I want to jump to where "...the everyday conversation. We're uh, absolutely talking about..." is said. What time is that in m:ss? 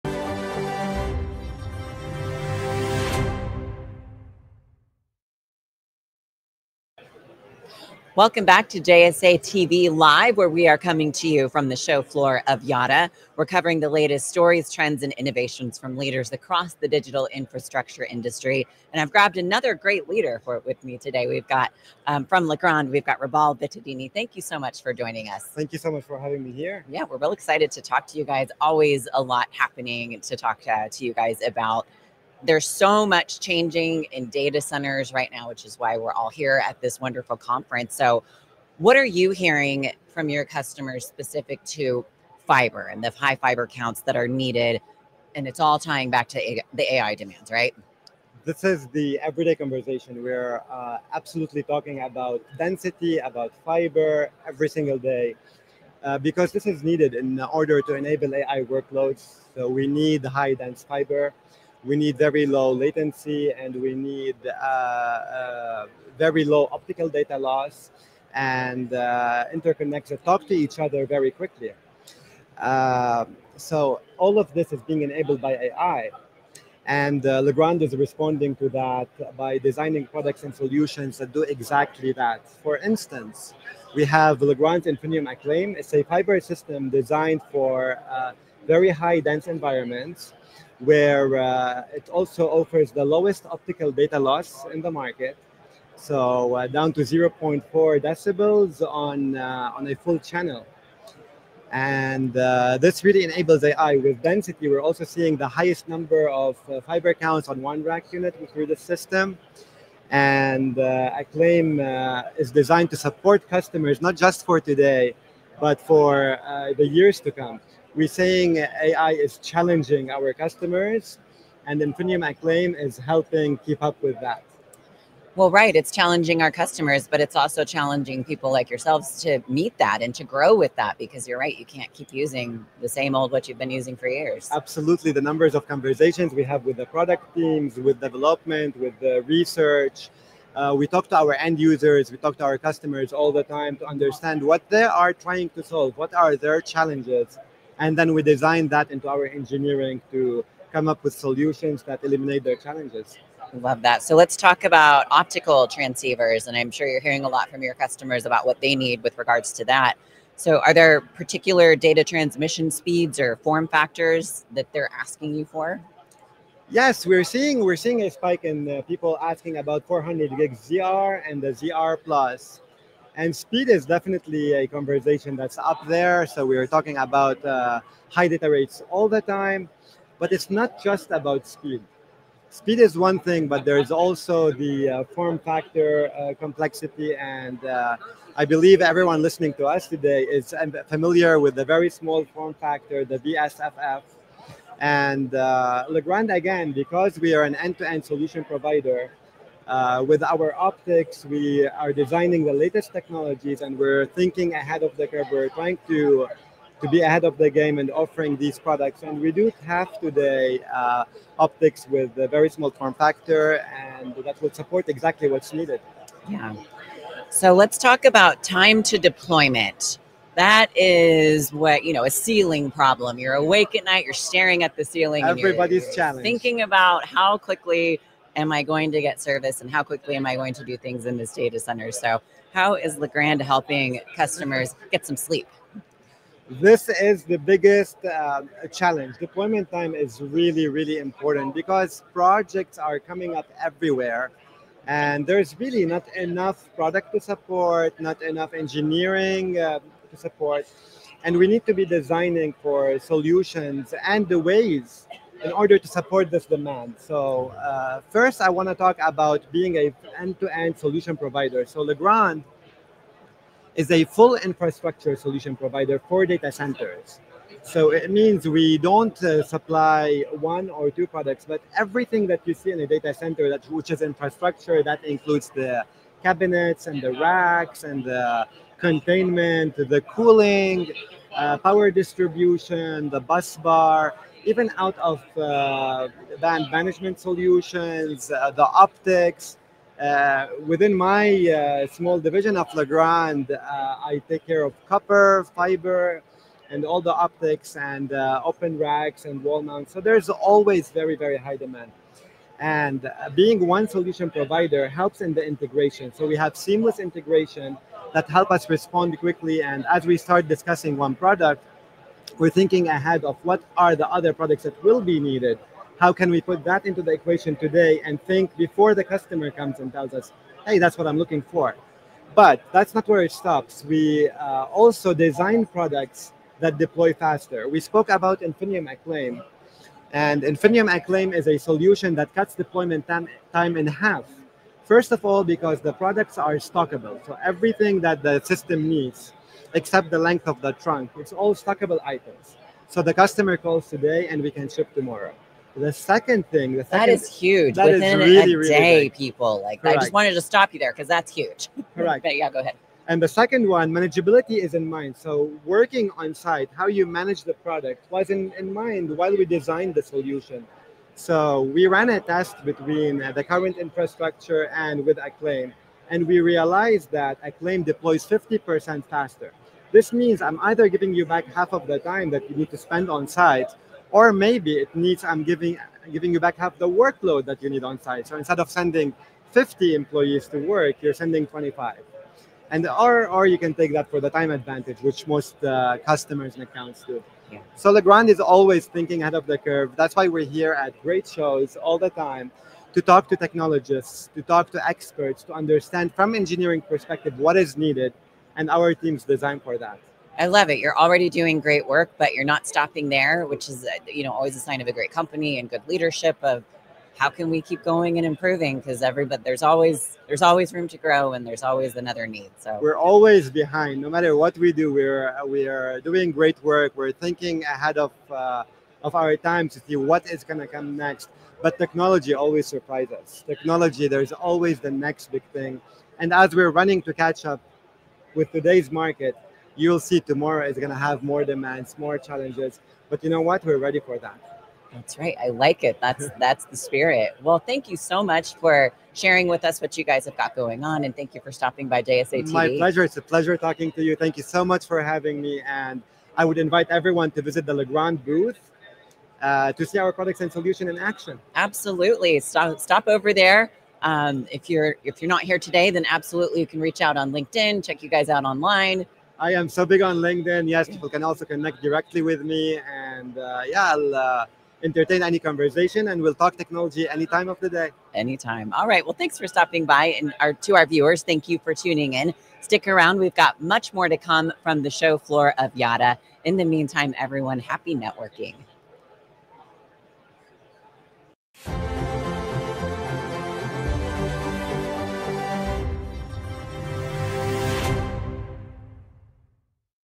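0:48.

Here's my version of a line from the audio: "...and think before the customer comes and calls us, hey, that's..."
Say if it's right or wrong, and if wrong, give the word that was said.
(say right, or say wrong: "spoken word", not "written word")
wrong: "tells", not "calls".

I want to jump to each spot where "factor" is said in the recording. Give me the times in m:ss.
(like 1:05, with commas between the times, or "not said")
2:43, 3:05, 3:12, 3:32.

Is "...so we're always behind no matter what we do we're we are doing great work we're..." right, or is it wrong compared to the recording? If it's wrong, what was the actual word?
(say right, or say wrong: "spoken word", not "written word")
right.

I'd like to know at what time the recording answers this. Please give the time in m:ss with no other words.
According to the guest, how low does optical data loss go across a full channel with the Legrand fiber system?
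1:37.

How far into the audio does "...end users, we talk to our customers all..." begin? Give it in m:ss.
2:21.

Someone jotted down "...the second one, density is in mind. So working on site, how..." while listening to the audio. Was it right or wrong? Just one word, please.
wrong.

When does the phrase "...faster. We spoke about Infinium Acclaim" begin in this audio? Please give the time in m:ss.
5:27.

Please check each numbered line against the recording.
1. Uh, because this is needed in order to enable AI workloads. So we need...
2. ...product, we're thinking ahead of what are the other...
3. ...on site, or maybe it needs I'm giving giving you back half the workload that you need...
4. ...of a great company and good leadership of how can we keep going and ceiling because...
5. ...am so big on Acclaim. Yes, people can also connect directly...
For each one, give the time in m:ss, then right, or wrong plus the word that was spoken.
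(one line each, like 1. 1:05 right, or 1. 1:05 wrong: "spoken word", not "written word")
1. 0:56 right
2. 5:11 right
3. 6:13 right
4. 6:44 wrong: "improving", not "ceiling"
5. 7:39 wrong: "LinkedIn", not "Acclaim".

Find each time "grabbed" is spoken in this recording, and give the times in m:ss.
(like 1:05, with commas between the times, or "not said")
0:19.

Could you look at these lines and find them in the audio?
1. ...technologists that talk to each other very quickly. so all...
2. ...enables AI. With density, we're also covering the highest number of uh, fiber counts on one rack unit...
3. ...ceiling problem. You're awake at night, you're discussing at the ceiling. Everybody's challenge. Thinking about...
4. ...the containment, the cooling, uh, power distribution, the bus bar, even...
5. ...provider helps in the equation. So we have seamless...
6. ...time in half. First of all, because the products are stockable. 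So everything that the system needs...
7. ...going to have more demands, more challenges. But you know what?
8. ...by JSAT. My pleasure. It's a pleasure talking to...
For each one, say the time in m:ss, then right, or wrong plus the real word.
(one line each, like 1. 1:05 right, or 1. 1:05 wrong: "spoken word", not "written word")
1. 1:09 wrong: "interconnects", not "technologists"
2. 1:43 wrong: "seeing", not "covering"
3. 3:42 wrong: "staring", not "discussing"
4. 4:38 right
5. 5:04 wrong: "integration", not "equation"
6. 5:33 right
7. 7:10 right
8. 7:21 right.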